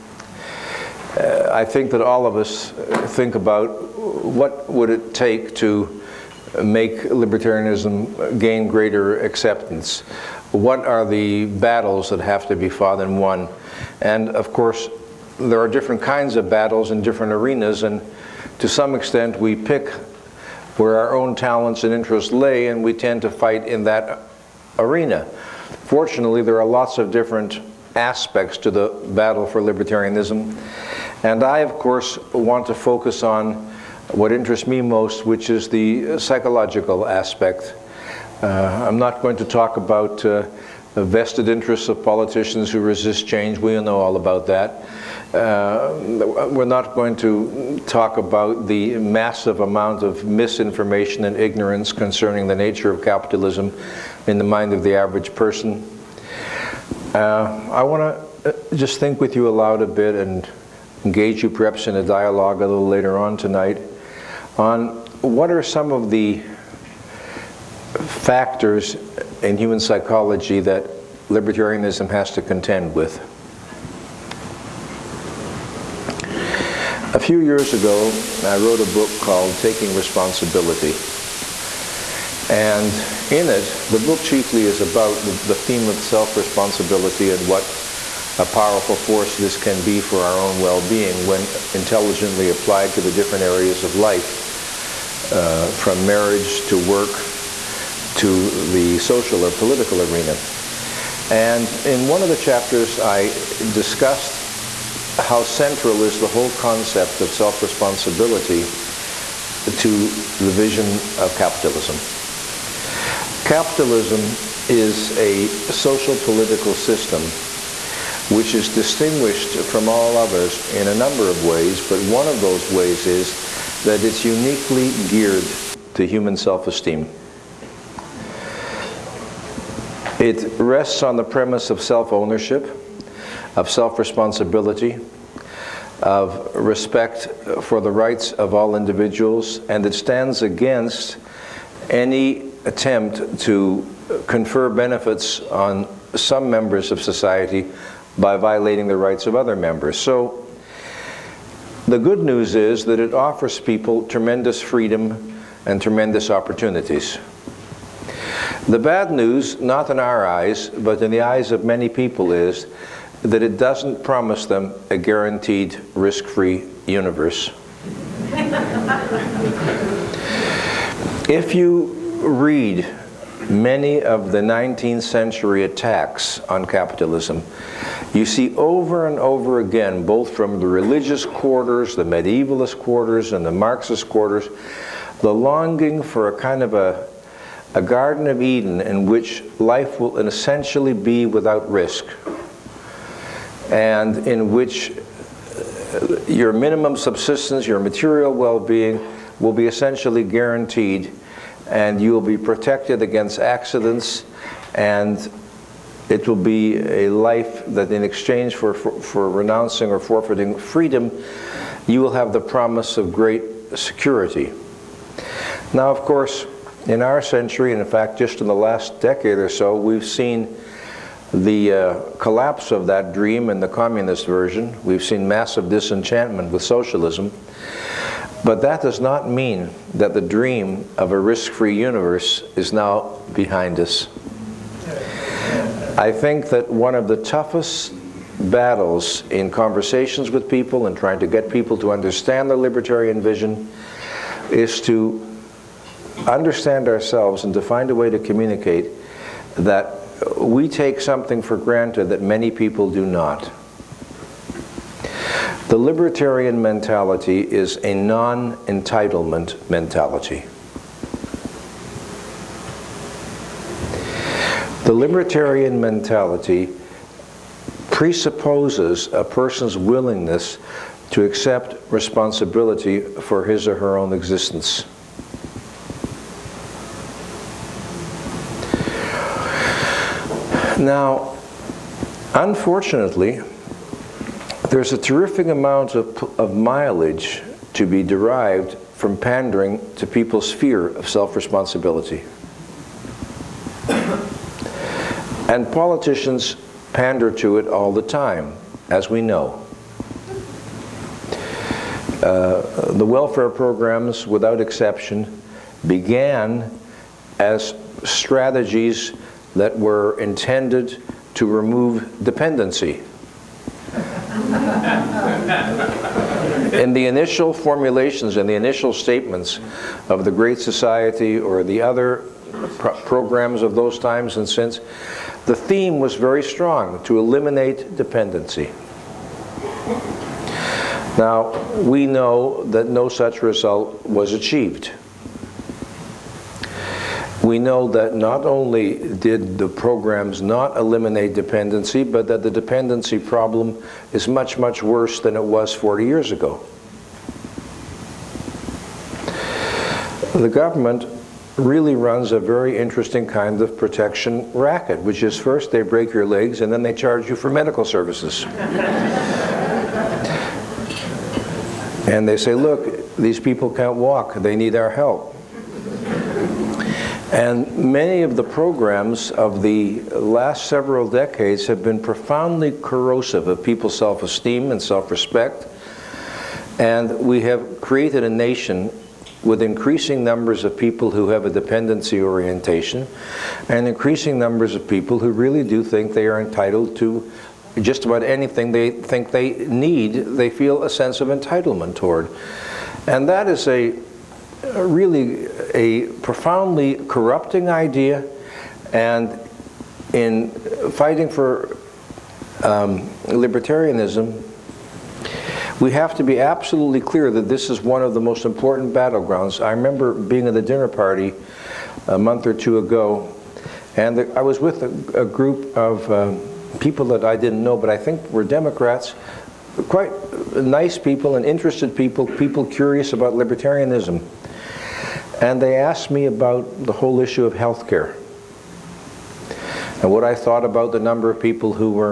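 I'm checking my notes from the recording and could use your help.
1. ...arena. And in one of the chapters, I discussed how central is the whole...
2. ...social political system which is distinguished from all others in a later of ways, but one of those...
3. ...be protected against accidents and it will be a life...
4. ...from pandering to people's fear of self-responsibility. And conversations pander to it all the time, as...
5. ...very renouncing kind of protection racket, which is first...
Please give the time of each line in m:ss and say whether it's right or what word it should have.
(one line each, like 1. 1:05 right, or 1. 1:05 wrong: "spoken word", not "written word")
1. 1:40 right
2. 1:55 wrong: "number", not "later"
3. 3:22 right
4. 4:48 wrong: "politicians", not "conversations"
5. 5:52 wrong: "interesting", not "renouncing".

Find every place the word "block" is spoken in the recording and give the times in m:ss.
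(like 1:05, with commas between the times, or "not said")
not said.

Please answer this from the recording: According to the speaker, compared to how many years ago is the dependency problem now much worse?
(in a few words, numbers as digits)
40.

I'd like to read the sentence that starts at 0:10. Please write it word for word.
What are the battles that have to be fought and won?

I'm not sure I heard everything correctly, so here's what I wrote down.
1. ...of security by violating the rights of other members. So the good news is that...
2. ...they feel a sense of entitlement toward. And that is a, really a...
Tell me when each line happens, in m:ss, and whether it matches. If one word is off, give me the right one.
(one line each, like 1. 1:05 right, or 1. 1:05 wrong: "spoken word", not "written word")
1. 2:26 wrong: "society", not "security"
2. 6:30 right.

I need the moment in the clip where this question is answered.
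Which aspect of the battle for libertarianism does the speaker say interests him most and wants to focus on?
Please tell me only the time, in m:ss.
0:36.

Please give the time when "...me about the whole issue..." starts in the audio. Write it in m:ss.
7:06.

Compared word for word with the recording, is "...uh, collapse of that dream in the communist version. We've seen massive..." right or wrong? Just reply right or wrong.
right.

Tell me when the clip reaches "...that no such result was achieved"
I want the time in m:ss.
5:32.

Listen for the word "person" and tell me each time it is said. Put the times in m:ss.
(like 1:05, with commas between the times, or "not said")
0:55, 4:29.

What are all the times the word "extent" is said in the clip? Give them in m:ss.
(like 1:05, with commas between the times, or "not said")
0:18.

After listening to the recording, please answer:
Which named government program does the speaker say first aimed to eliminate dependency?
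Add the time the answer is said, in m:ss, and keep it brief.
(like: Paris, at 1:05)
Great Society, at 5:20.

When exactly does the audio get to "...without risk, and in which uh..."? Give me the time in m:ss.
3:11.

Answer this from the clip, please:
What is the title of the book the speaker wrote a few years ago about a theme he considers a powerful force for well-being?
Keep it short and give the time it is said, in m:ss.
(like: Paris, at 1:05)
Taking Responsibility, at 1:19.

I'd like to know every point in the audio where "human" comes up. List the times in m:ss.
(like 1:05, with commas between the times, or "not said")
1:09, 2:06.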